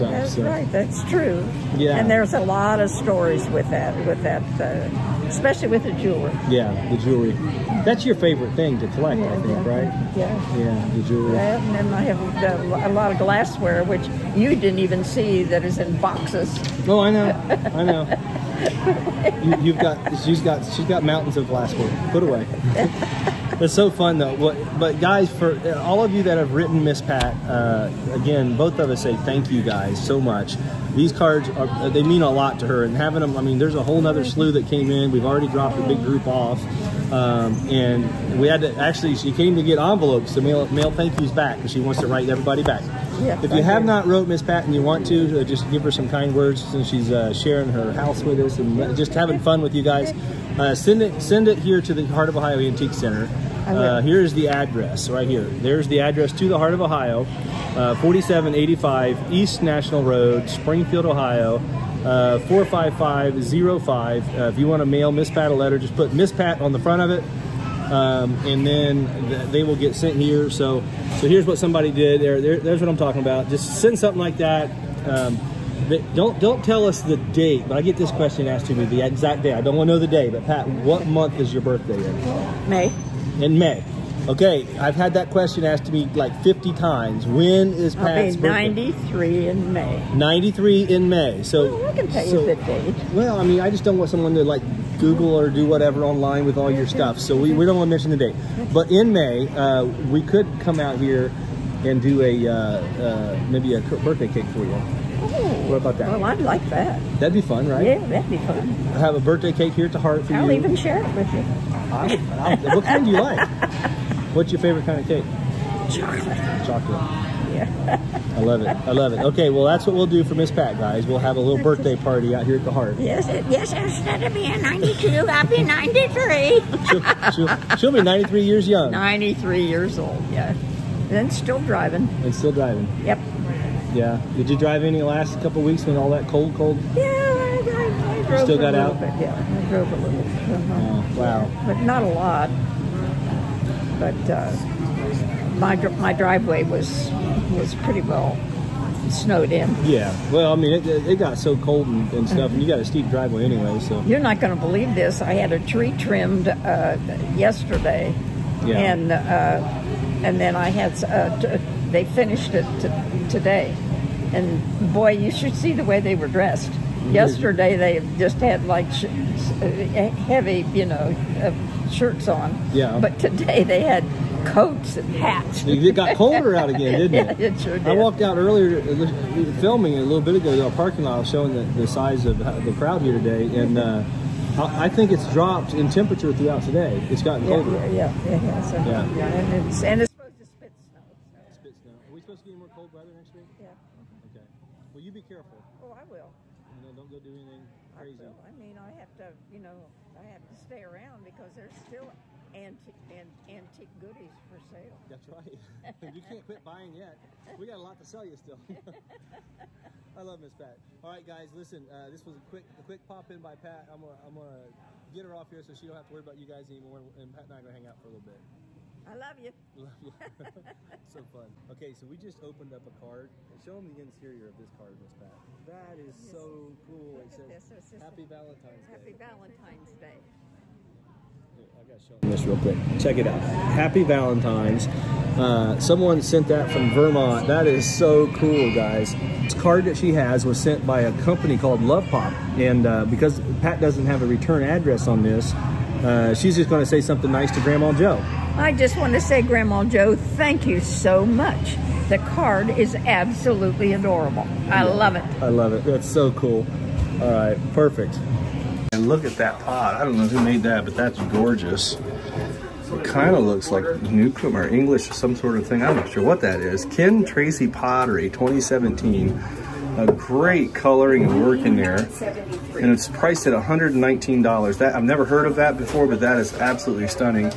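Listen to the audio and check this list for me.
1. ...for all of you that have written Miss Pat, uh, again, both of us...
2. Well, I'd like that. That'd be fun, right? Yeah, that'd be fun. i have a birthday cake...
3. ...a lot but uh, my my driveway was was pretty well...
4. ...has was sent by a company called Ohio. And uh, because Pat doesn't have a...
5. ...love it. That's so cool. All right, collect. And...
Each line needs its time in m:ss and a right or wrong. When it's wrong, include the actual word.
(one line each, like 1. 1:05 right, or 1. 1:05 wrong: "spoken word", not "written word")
1. 0:25 right
2. 1:46 right
3. 2:22 right
4. 4:00 wrong: "Lovepop", not "Ohio"
5. 4:15 wrong: "perfect", not "collect".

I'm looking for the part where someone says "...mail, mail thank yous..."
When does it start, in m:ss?
0:40.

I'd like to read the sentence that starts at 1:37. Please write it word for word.
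So we, we don't want to mention the date.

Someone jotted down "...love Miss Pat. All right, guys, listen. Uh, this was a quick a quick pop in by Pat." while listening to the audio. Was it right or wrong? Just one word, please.
right.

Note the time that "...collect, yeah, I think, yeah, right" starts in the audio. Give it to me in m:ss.
0:08.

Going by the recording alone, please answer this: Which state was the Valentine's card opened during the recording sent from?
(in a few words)
Vermont.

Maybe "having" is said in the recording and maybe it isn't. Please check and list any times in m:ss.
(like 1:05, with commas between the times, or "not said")
0:32, 0:49.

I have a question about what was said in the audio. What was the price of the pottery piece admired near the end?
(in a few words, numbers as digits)
$119.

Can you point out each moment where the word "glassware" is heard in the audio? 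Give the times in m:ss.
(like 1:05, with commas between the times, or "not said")
0:13, 0:21.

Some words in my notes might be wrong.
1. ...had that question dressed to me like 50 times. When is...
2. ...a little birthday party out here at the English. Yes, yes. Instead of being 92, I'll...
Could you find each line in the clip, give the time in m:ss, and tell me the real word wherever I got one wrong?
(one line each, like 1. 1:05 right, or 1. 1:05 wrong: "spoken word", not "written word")
1. 1:24 wrong: "asked", not "dressed"
2. 2:01 wrong: "Heart", not "English".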